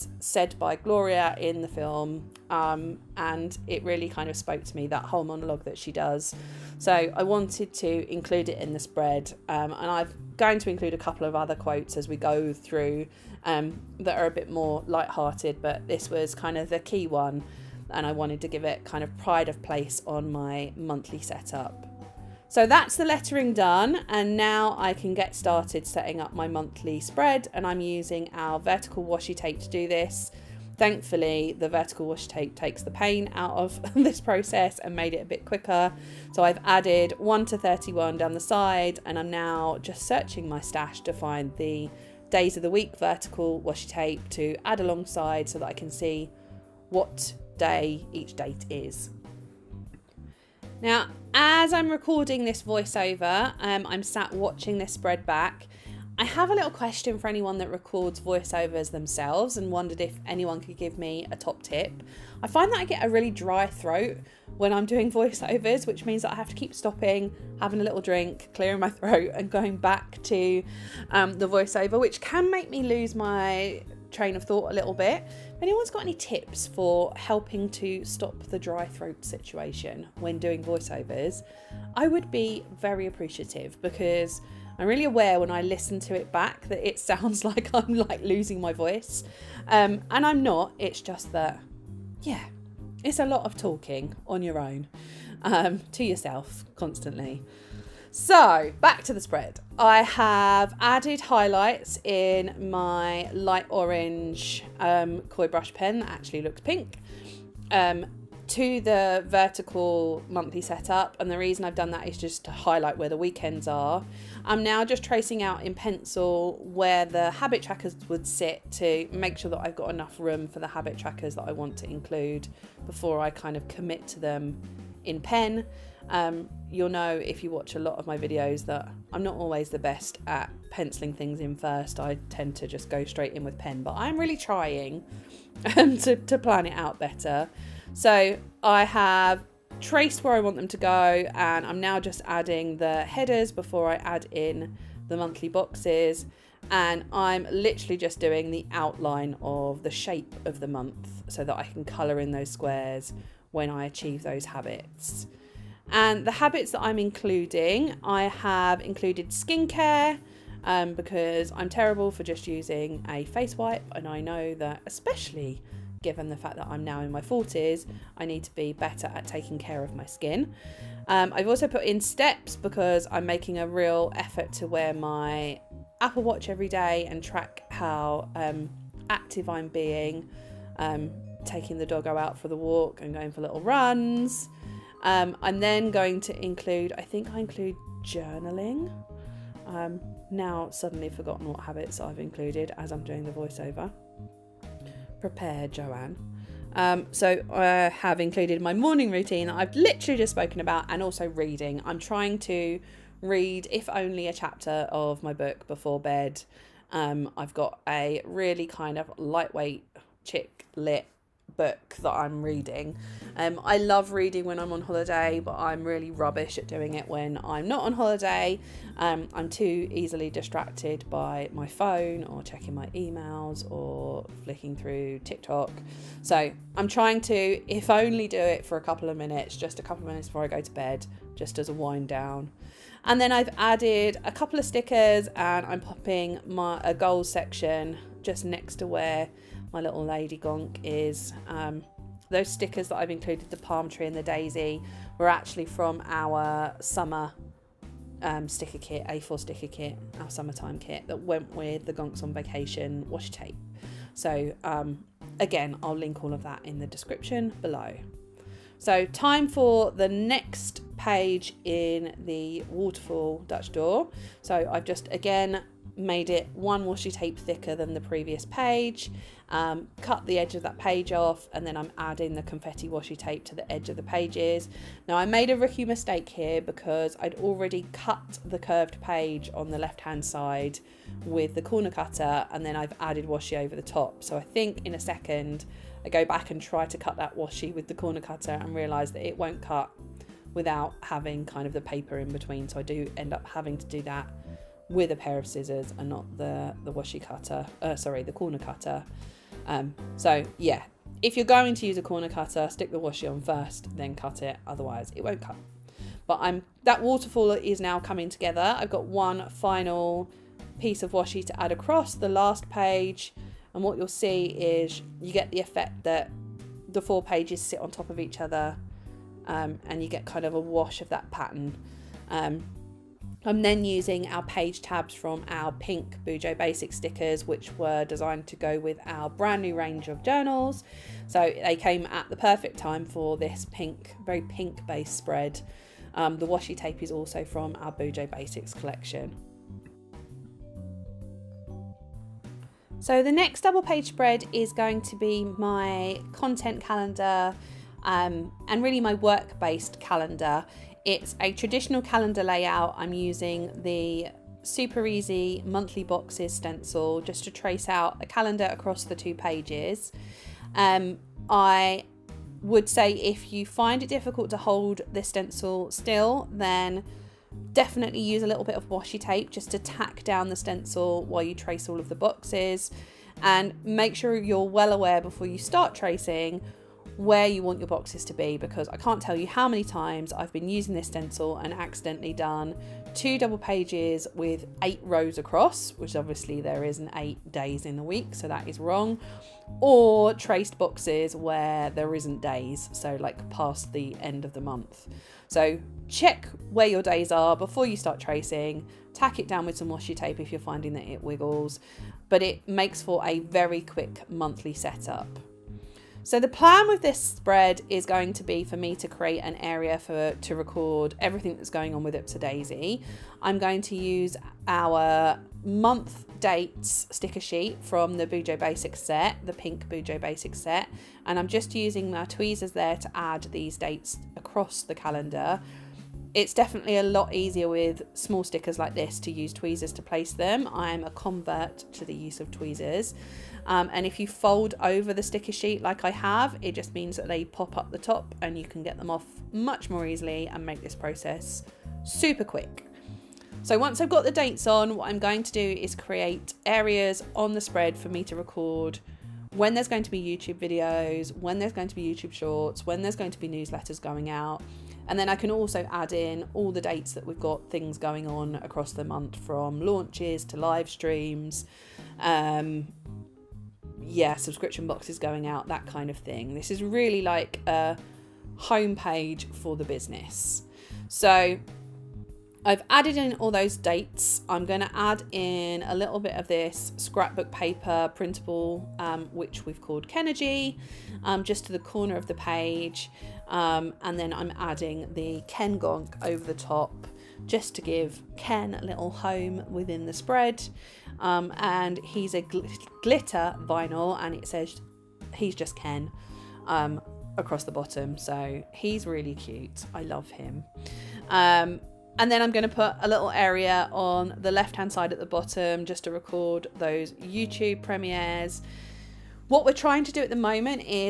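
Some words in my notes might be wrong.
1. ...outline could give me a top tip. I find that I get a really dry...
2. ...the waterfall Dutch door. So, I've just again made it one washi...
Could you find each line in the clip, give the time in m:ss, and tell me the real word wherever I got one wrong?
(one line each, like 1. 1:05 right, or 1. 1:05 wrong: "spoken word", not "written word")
1. 1:00 wrong: "anyone", not "outline"
2. 4:22 right.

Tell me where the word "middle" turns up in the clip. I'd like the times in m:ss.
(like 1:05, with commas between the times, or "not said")
not said.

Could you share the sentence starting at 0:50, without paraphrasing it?
Now, as I'm recording this voiceover, um, I'm sat watching this spread back.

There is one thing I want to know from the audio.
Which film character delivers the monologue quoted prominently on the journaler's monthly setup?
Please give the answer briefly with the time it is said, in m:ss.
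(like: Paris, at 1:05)
Gloria, at 0:00.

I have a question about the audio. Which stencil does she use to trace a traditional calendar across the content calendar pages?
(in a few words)
super easy monthly boxes.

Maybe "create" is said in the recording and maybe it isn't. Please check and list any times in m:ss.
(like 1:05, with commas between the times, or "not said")
6:49, 7:25.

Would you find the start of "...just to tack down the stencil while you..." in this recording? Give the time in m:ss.
6:09.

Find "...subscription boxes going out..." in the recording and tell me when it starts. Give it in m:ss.
7:44.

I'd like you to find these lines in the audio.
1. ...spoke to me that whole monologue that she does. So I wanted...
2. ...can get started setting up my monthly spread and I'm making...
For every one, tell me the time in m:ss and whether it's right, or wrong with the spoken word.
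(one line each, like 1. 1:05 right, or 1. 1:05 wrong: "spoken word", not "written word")
1. 0:04 right
2. 0:24 wrong: "using", not "making".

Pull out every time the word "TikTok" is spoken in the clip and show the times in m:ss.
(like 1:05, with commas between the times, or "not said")
3:45.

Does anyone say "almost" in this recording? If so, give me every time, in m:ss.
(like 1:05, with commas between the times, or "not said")
not said.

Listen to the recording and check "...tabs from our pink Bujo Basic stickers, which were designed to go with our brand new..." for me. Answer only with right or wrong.
right.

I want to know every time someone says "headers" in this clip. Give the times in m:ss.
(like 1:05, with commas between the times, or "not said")
2:23.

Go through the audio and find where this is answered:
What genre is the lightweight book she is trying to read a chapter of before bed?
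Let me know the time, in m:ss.
3:30.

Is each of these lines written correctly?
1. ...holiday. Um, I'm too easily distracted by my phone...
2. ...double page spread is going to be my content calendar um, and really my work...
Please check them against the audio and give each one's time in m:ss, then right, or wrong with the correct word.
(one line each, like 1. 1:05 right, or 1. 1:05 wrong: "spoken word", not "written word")
1. 3:37 right
2. 5:43 right.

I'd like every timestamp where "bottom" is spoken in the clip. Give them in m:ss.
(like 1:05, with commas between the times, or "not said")
8:17, 8:25.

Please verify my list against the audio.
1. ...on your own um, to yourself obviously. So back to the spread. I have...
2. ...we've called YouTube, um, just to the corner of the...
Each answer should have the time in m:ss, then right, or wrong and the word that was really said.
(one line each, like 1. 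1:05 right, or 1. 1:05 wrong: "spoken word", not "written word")
1. 1:34 wrong: "constantly", not "obviously"
2. 7:59 wrong: "Kennergy", not "YouTube".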